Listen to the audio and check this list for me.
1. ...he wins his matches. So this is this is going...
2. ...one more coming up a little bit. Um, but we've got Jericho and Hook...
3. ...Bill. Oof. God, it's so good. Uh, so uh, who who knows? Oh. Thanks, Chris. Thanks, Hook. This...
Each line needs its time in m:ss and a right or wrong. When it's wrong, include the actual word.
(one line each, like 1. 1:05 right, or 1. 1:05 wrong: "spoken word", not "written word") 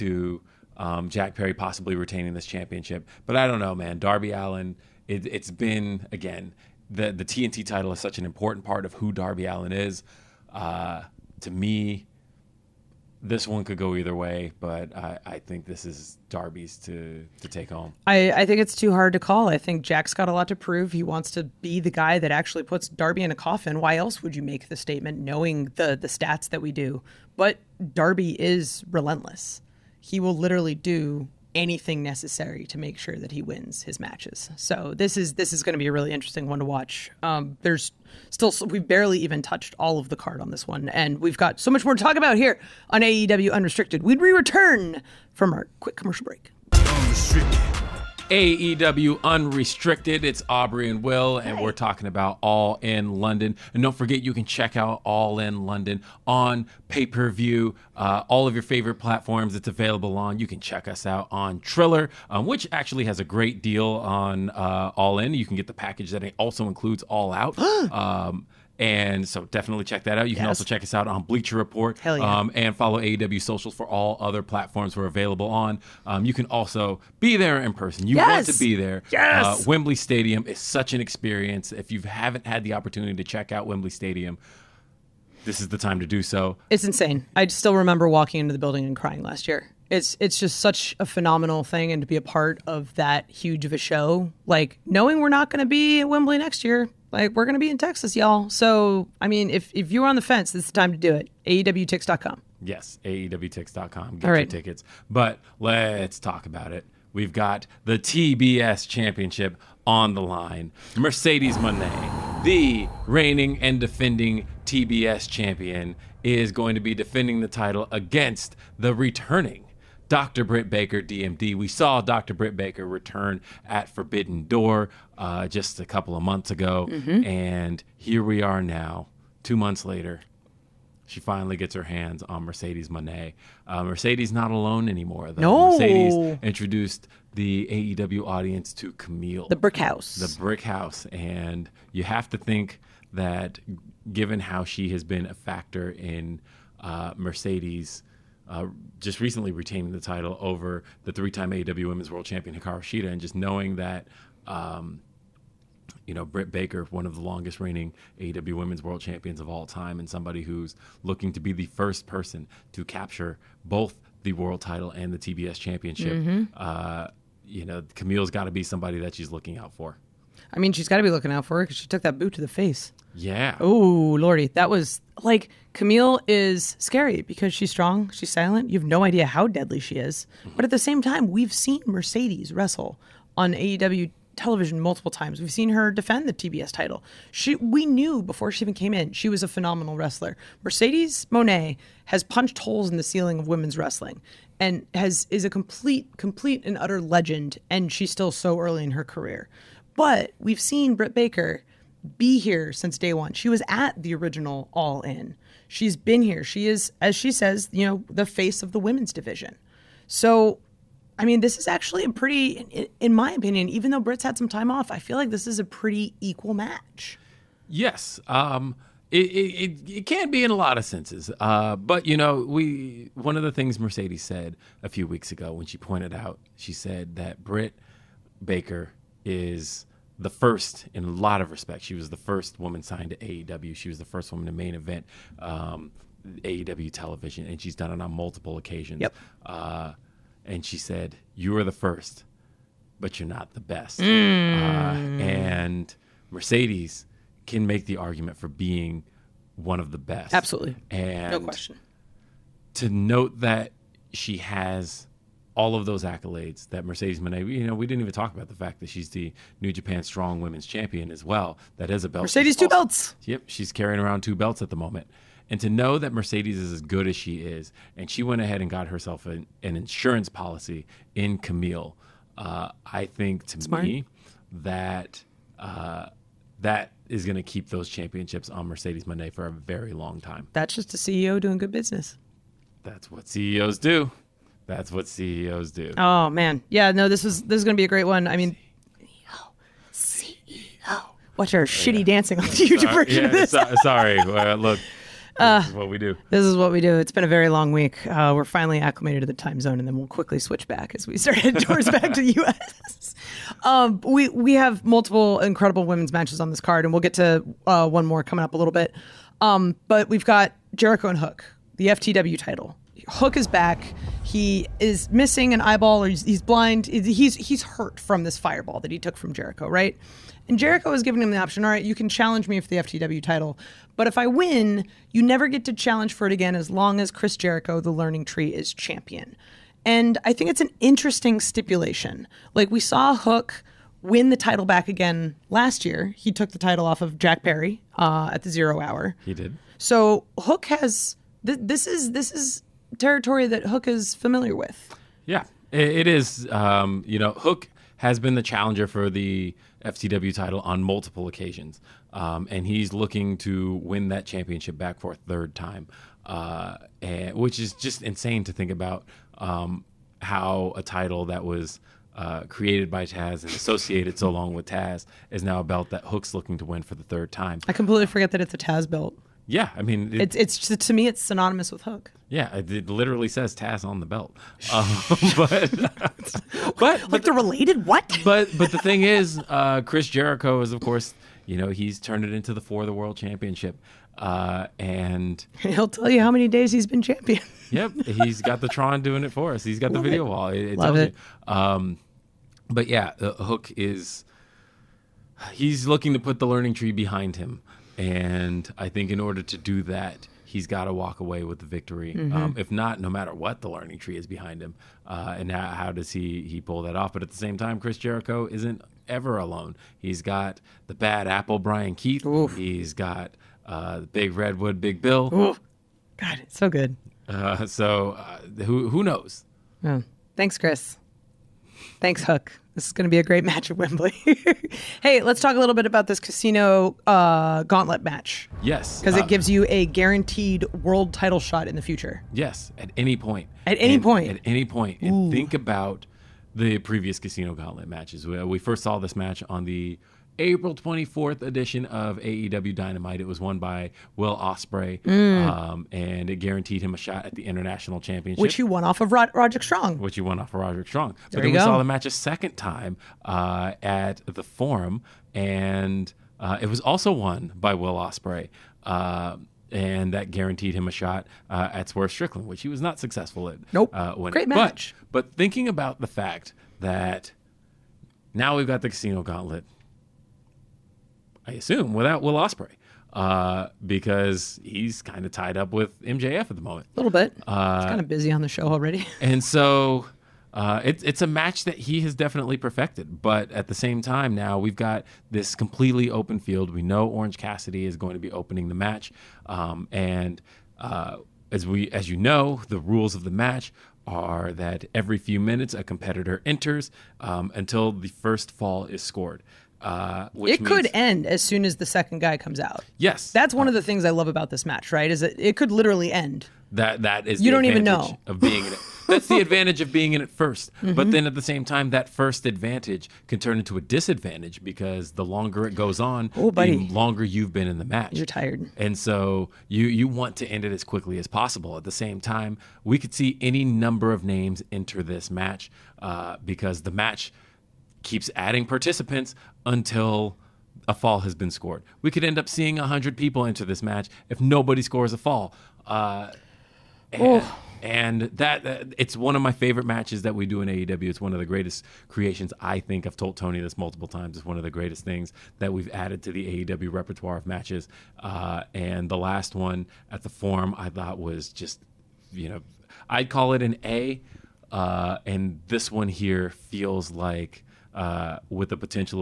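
1. 0:33 right
2. 5:07 right
3. 6:55 right.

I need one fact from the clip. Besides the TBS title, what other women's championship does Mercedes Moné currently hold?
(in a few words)
New Japan Strong Women's Champion.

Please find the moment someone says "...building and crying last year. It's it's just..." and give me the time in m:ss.
1:28.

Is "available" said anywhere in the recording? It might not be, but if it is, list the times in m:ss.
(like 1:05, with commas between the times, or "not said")
0:59, 1:15.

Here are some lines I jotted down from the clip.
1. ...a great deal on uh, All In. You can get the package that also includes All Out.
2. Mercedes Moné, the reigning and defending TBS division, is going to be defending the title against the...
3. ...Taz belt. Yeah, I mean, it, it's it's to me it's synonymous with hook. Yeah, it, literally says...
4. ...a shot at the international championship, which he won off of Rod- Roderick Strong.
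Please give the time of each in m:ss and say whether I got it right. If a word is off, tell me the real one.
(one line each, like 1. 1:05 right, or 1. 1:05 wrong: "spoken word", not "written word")
1. 1:03 right
2. 1:50 wrong: "champion", not "division"
3. 6:08 right
4. 7:26 right.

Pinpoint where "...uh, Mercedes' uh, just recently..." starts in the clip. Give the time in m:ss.
2:26.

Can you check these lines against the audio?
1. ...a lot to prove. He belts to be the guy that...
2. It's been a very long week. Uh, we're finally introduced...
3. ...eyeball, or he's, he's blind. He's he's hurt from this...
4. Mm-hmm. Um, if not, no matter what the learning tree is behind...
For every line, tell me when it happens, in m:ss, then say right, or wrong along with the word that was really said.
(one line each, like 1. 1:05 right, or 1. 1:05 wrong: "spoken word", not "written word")
1. 0:20 wrong: "wants", not "belts"
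2. 4:56 wrong: "acclimated", not "introduced"
3. 5:15 right
4. 6:42 right.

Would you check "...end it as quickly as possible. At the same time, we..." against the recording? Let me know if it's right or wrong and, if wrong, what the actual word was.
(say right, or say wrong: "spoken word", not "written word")
right.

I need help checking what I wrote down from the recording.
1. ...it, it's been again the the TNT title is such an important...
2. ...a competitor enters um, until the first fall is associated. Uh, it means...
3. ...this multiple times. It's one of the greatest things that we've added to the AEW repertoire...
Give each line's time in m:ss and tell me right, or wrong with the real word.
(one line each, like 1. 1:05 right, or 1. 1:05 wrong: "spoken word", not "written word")
1. 0:05 right
2. 8:15 wrong: "scored", not "associated"
3. 9:03 right.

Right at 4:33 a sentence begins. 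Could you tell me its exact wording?
me that uh, that is going to keep those championships on Mercedes Moné for a very long time.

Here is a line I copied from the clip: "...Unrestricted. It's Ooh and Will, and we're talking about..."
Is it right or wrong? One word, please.
wrong.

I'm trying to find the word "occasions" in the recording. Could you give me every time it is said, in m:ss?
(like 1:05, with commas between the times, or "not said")
3:58, 5:51.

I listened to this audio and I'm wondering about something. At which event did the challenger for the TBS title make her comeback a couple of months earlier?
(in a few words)
Forbidden Door.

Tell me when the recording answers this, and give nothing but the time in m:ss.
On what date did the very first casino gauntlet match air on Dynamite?
7:20.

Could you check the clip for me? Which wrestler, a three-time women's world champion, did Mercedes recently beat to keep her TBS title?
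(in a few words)
Hikaru Shida.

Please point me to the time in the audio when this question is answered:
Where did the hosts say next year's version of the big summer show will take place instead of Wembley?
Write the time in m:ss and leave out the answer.
1:37.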